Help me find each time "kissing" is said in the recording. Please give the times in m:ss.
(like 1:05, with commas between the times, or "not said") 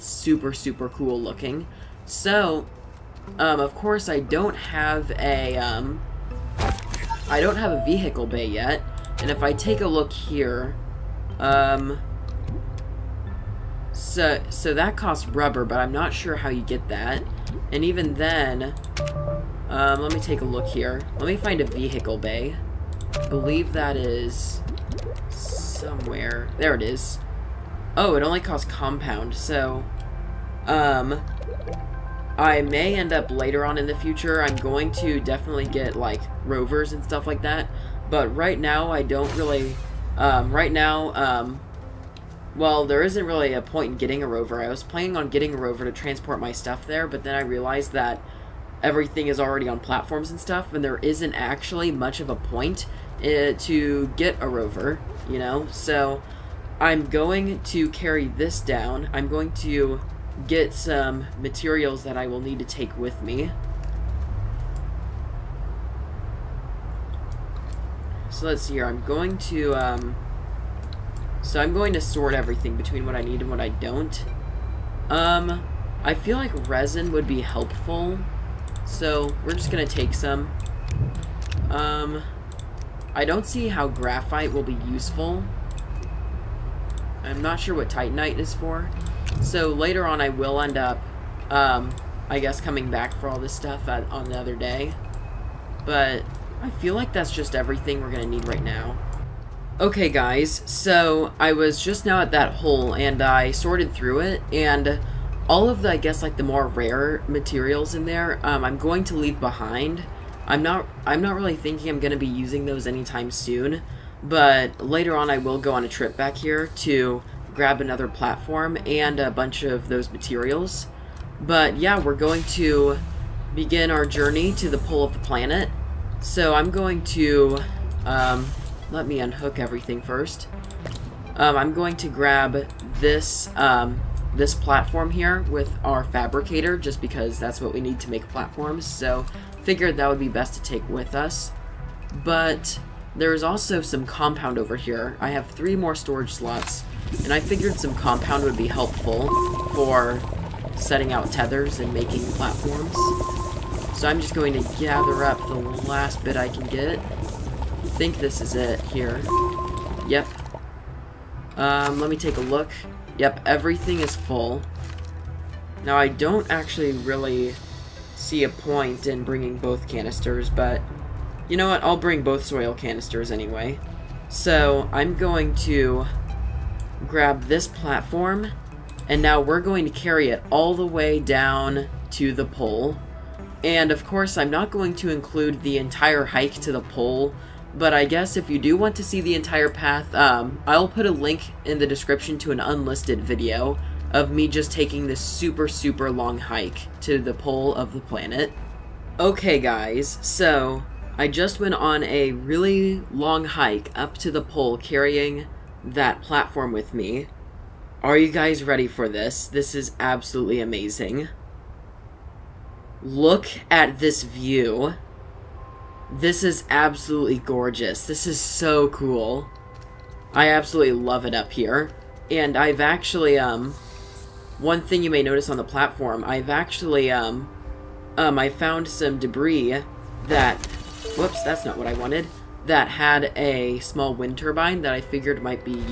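not said.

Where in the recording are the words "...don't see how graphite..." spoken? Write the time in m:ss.
1:23.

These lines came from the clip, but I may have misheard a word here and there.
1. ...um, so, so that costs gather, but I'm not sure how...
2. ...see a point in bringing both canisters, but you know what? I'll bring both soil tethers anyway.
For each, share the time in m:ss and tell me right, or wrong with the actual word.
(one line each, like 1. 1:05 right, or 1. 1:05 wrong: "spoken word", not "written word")
1. 0:11 wrong: "rubber", not "gather"
2. 2:48 wrong: "canisters", not "tethers".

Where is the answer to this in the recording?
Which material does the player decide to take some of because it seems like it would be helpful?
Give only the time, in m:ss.
1:16.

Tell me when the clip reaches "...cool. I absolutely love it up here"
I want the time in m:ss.
3:38.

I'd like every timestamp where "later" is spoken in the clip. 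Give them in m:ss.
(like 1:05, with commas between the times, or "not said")
0:33, 1:29, 1:54.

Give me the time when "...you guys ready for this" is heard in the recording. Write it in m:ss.
3:28.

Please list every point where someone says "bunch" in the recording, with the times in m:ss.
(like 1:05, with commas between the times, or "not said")
1:59.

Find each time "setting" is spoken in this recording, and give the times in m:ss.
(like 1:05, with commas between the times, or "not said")
2:30.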